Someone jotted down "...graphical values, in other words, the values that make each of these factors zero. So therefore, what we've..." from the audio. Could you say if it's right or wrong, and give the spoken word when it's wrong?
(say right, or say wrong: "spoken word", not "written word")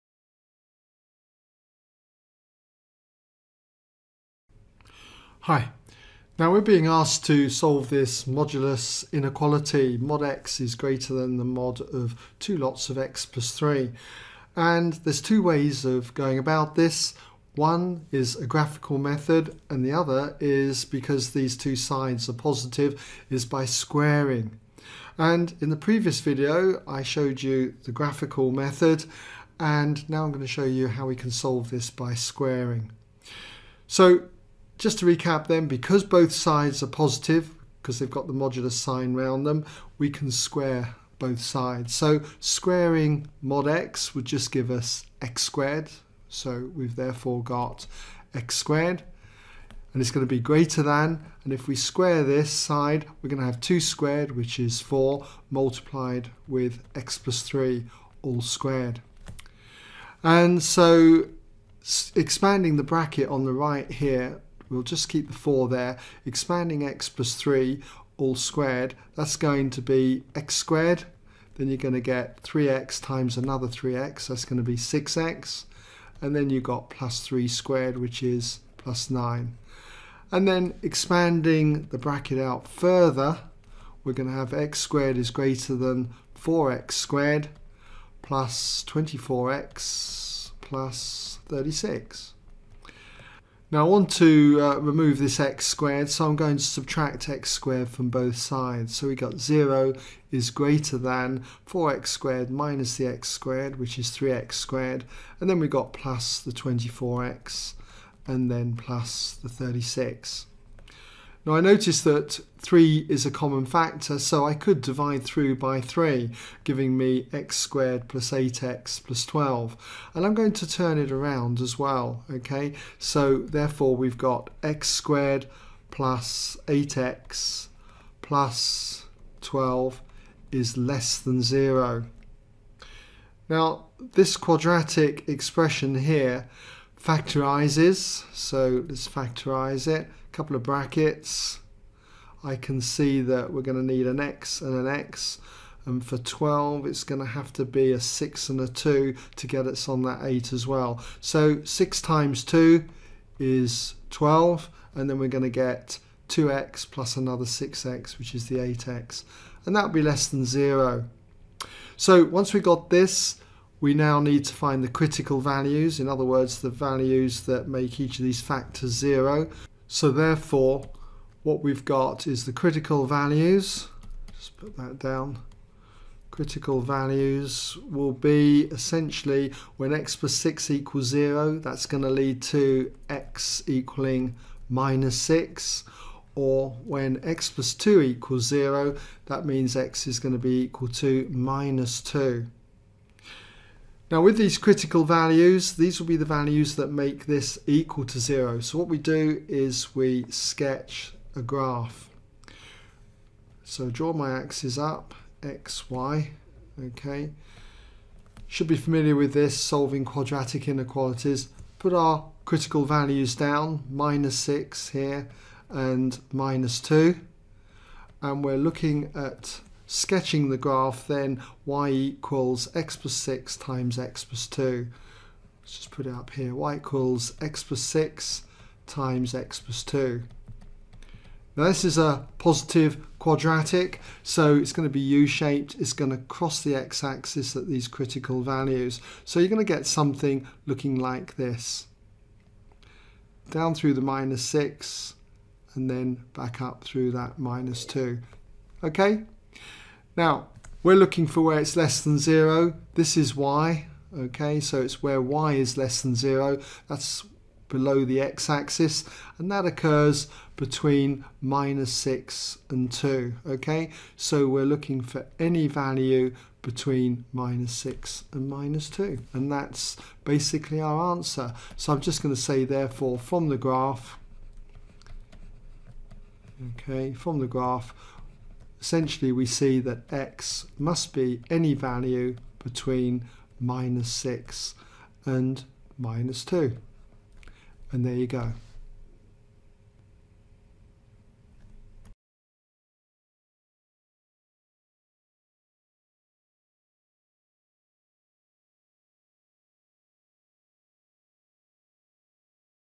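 wrong: "critical", not "graphical".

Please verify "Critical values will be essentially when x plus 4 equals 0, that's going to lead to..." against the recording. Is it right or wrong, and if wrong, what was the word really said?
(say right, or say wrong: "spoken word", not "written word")
wrong: "6", not "4".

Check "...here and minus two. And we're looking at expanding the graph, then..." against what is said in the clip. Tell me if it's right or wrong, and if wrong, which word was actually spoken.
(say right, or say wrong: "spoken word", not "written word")
wrong: "sketching", not "expanding".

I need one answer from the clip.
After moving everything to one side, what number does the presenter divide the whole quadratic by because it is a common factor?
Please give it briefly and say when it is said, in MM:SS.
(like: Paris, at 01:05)
3, at 01:54.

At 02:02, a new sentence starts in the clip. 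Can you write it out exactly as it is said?
So therefore we've got x squared plus 8x plus 12 is less than 0.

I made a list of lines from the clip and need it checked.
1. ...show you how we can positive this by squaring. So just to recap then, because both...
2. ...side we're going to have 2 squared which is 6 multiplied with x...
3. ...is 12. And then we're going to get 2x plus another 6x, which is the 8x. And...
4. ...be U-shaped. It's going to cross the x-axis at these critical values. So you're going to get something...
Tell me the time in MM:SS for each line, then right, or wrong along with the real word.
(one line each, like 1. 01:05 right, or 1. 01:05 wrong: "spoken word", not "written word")
1. 00:30 wrong: "solve", not "positive"
2. 00:52 wrong: "4", not "6"
3. 02:33 right
4. 03:54 right.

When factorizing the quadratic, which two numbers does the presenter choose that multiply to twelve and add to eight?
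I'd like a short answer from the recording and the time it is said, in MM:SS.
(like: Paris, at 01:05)
6 and 2, at 02:27.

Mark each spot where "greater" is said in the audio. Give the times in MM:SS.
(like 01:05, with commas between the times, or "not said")
00:10, 00:50, 01:25, 01:40.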